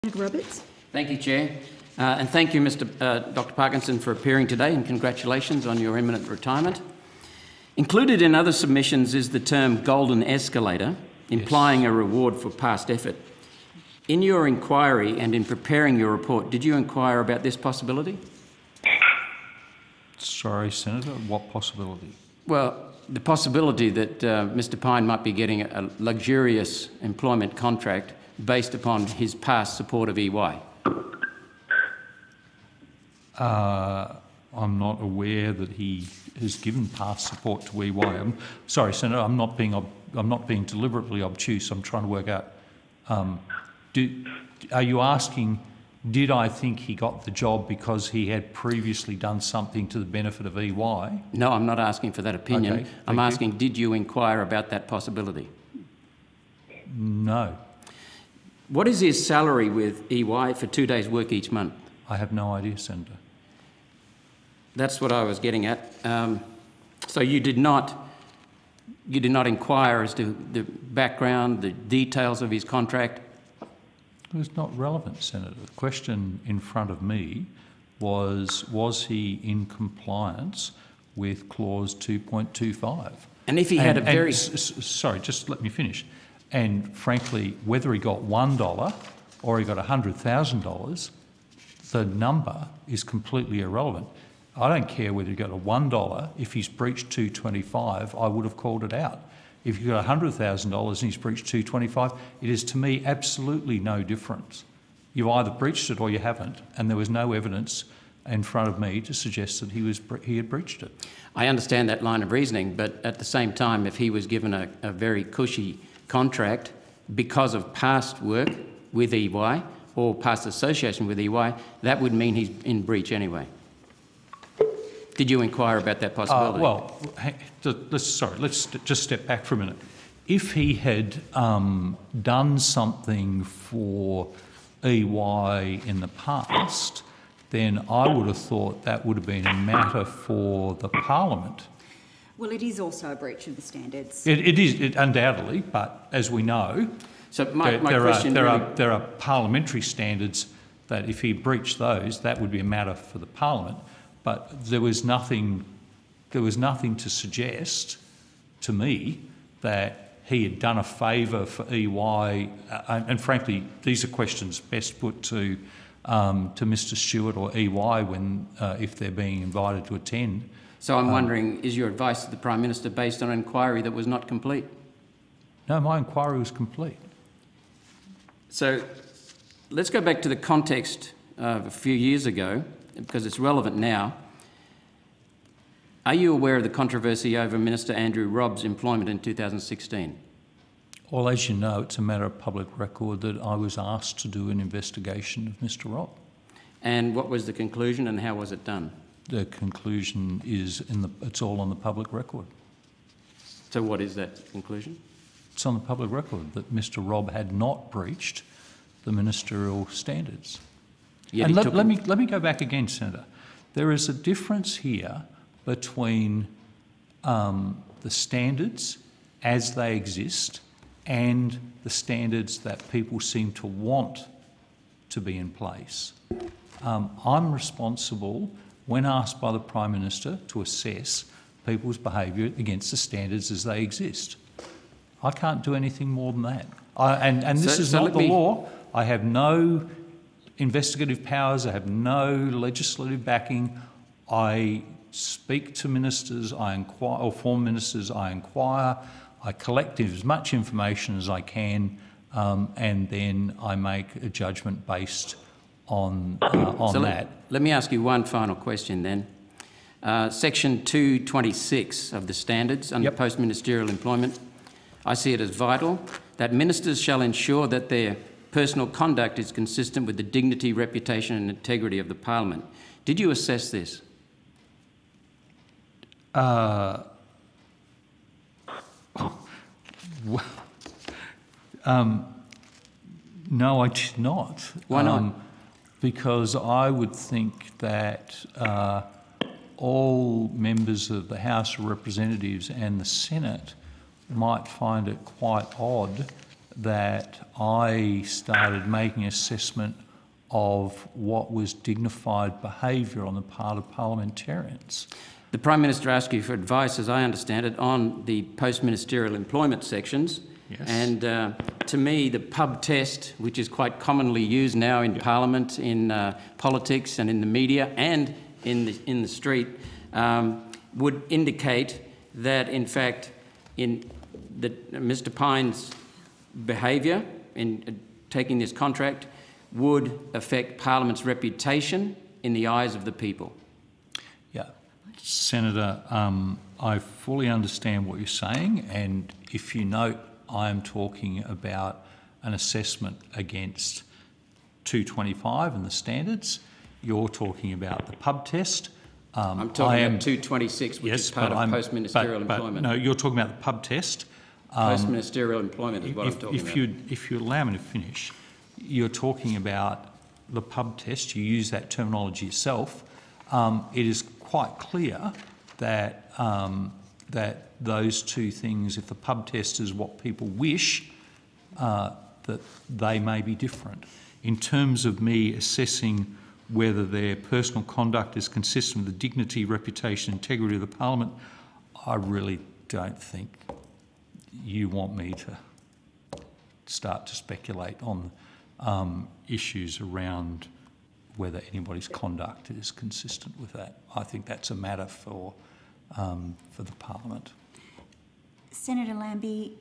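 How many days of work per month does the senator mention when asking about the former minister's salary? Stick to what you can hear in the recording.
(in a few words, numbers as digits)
2.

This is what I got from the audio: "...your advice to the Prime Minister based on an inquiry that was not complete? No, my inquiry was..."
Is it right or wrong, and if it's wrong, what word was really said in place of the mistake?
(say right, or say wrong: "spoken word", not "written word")
right.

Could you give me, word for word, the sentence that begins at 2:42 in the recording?
Uh, and frankly, these are questions best put to um, to Mr.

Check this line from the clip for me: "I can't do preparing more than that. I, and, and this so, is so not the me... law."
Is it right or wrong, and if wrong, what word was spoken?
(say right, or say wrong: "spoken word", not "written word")
wrong: "anything", not "preparing".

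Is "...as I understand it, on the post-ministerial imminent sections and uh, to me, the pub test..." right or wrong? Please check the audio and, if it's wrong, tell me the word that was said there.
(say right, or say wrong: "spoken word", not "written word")
wrong: "employment", not "imminent".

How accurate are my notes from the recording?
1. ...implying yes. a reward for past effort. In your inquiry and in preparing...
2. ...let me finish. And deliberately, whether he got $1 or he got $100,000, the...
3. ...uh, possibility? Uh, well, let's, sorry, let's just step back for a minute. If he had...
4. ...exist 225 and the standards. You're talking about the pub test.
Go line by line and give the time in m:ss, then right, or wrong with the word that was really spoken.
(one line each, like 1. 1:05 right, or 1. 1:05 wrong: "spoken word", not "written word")
1. 0:11 right
2. 1:25 wrong: "frankly", not "deliberately"
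3. 2:06 right
4. 5:43 wrong: "against", not "exist".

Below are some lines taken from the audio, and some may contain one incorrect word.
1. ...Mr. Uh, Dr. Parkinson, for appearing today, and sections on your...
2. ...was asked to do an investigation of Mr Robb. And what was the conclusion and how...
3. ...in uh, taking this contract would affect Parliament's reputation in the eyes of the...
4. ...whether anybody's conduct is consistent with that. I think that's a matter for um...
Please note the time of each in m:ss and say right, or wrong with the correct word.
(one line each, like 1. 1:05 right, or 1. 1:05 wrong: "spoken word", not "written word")
1. 0:02 wrong: "congratulations", not "sections"
2. 3:13 right
3. 5:27 right
4. 6:31 right.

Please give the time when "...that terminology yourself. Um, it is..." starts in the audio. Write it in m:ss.
6:01.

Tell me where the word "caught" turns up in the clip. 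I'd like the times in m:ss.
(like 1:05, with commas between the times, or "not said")
not said.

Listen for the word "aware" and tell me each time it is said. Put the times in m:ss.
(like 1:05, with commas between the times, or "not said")
0:35, 3:06.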